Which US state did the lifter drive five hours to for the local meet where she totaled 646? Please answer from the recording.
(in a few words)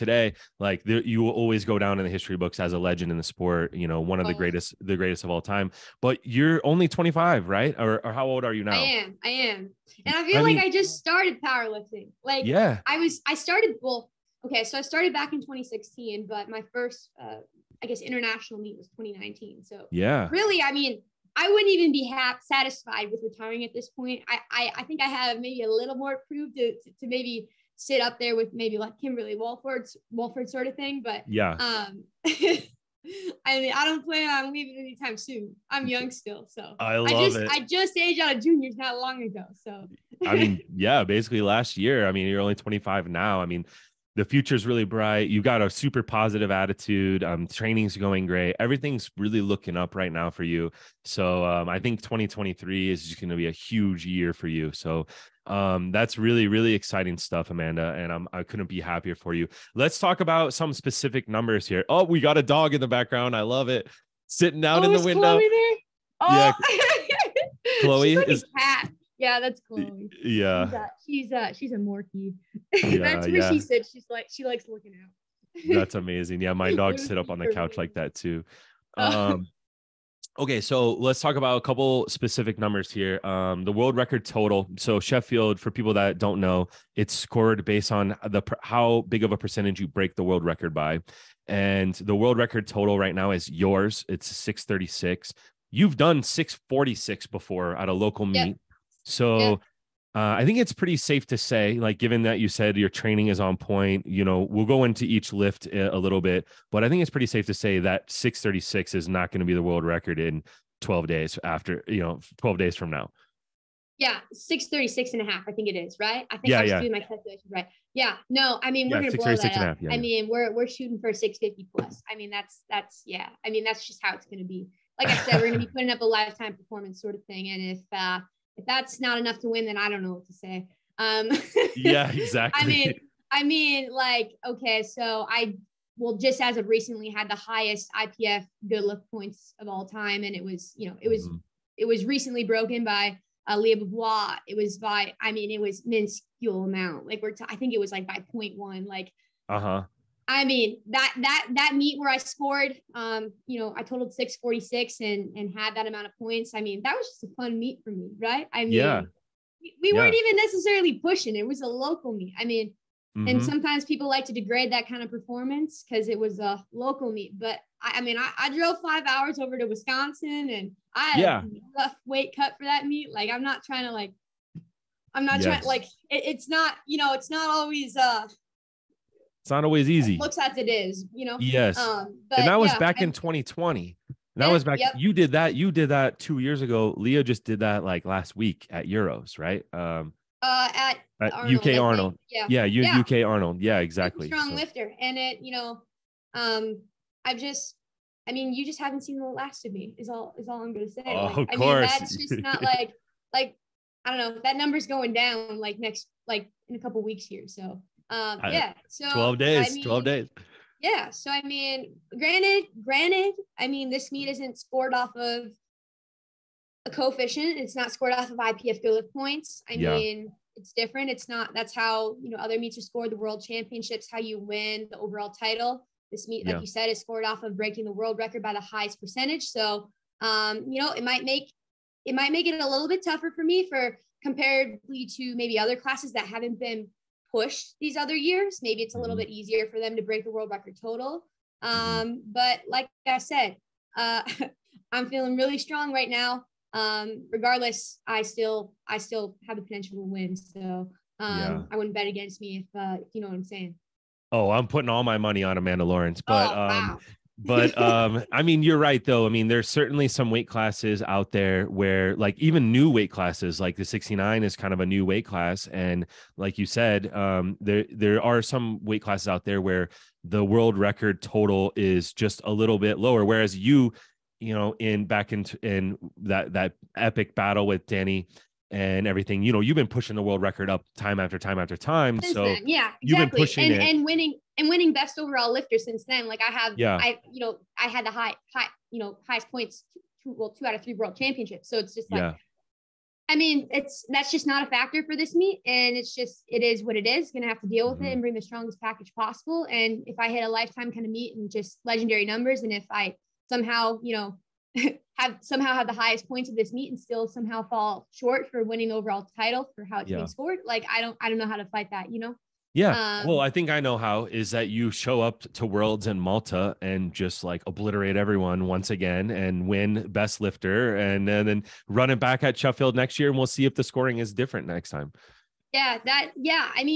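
Wisconsin.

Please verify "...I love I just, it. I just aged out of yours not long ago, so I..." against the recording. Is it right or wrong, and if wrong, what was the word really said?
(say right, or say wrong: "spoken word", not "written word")
wrong: "juniors", not "yours".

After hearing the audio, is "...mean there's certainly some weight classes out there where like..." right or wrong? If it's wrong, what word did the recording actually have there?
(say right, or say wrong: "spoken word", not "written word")
right.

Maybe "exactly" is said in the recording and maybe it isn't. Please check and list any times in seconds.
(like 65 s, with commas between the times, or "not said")
132 s, 193 s, 282 s.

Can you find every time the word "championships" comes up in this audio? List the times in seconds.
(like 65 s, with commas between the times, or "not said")
223 s, 291 s.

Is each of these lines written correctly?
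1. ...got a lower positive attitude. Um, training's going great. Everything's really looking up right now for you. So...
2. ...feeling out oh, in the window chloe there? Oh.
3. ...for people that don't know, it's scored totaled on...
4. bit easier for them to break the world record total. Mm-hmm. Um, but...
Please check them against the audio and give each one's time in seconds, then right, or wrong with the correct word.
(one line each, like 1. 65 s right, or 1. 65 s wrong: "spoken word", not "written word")
1. 45 s wrong: "super", not "lower"
2. 64 s wrong: "sitting", not "feeling"
3. 85 s wrong: "based", not "totaled"
4. 239 s right.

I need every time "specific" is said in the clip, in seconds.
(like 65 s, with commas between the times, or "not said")
60 s, 82 s.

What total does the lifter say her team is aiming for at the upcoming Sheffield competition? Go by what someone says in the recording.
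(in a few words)
650 plus.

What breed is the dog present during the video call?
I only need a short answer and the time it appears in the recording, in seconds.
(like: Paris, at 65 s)
Morkie, at 71 s.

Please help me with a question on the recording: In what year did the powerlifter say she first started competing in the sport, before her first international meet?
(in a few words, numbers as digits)
2016.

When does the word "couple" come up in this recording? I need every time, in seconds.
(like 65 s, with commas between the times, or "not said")
81 s, 206 s.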